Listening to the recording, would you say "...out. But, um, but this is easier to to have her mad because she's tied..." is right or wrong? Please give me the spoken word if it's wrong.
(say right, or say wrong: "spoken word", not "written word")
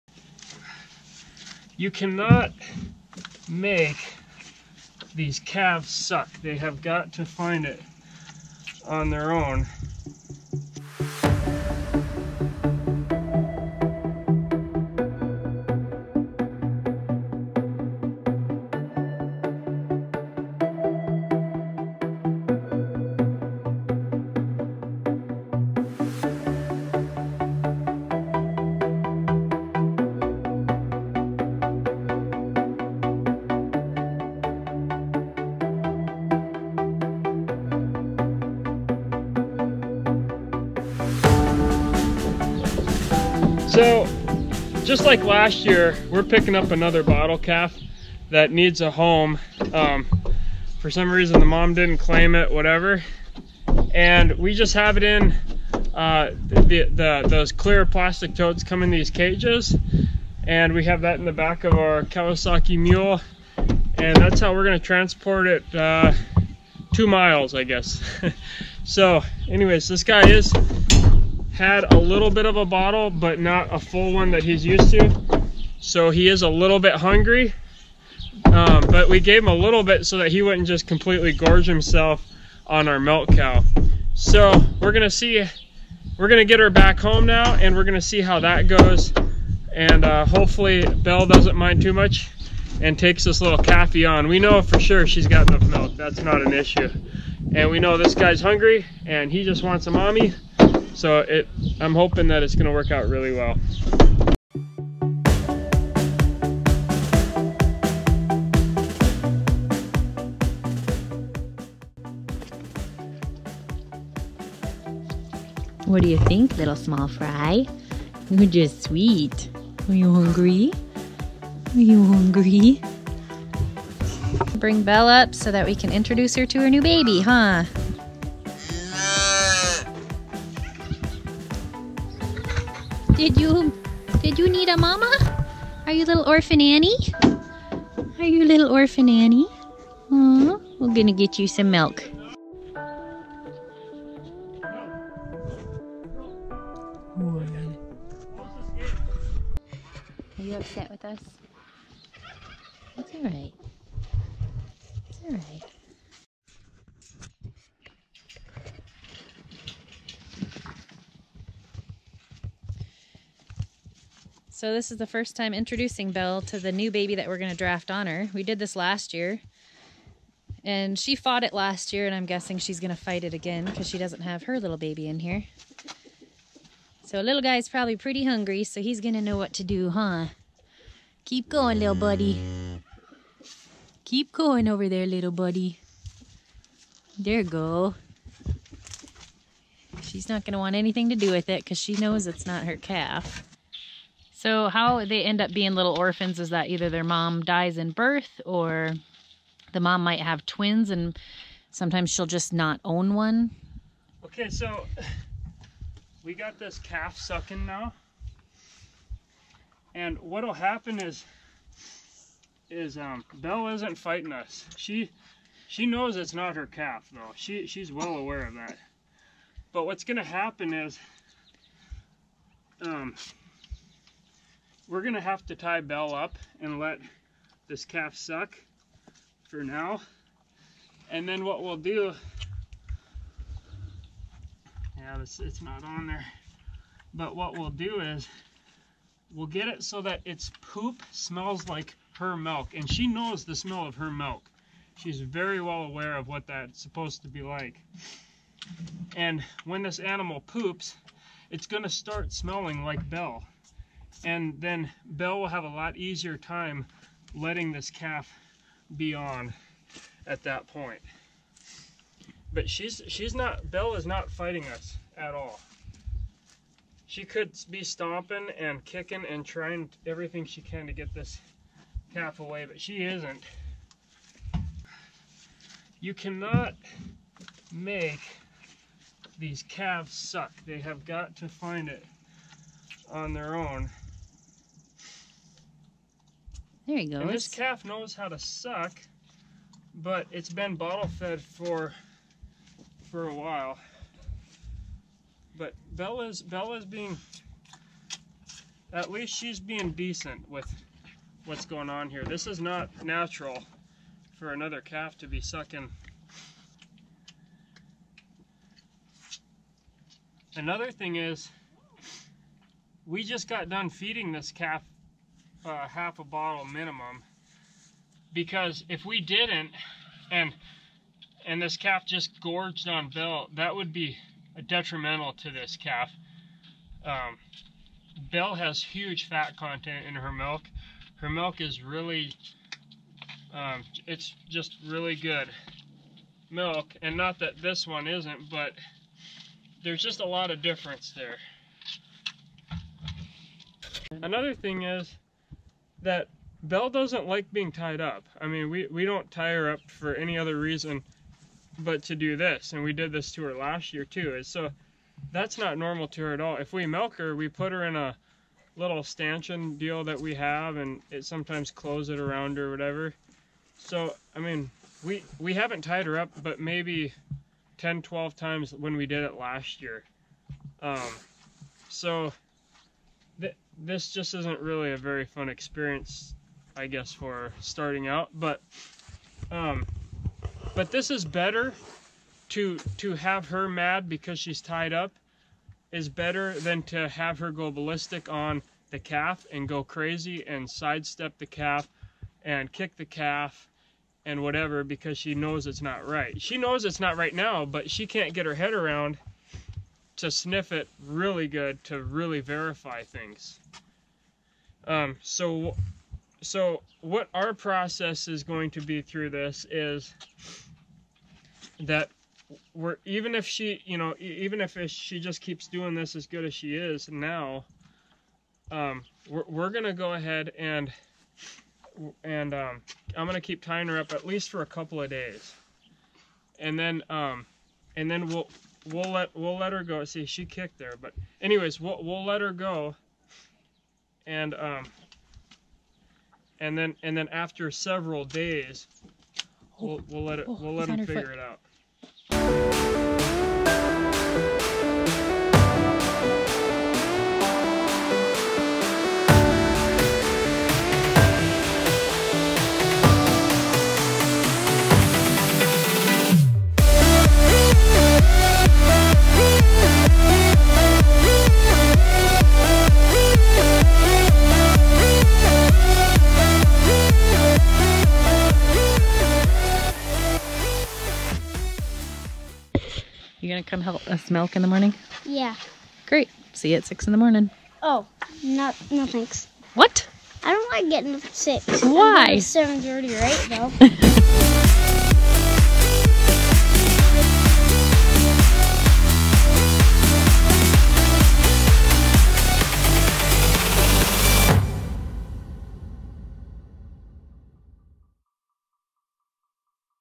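wrong: "better", not "easier".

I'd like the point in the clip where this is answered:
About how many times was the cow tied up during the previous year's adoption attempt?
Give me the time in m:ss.
6:07.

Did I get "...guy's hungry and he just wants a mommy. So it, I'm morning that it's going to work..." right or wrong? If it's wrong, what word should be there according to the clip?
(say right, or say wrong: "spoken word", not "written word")
wrong: "hoping", not "morning".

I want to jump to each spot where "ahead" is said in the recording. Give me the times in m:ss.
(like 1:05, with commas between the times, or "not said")
7:00.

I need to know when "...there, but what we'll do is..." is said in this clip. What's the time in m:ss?
3:56.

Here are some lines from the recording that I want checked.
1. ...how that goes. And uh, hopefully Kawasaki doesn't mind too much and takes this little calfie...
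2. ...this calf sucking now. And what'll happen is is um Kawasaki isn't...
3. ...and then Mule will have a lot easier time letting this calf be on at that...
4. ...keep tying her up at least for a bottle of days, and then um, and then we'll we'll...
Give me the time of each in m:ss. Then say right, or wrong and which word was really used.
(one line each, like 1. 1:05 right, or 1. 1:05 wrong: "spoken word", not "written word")
1. 1:28 wrong: "Belle", not "Kawasaki"
2. 3:26 wrong: "Belle", not "Kawasaki"
3. 4:14 wrong: "Belle", not "Mule"
4. 7:03 wrong: "couple", not "bottle".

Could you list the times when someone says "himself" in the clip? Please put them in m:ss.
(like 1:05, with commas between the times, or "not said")
1:21.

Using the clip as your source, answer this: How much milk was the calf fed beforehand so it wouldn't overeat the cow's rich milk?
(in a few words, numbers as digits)
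Half a bottle.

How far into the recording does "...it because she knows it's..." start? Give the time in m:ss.
3:11.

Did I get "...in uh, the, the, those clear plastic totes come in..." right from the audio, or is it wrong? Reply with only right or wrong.
right.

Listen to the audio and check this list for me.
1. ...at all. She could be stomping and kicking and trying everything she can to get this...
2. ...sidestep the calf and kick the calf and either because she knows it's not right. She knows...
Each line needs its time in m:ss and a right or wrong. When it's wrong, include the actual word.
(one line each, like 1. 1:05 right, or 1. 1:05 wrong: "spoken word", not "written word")
1. 4:25 right
2. 6:30 wrong: "whatever", not "either".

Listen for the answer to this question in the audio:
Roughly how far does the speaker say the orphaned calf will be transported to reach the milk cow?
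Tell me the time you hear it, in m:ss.
1:06.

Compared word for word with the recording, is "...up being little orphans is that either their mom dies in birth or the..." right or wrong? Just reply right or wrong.
right.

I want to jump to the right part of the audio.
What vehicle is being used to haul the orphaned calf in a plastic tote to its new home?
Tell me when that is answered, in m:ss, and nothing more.
1:02.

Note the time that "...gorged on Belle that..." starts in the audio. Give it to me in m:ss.
5:22.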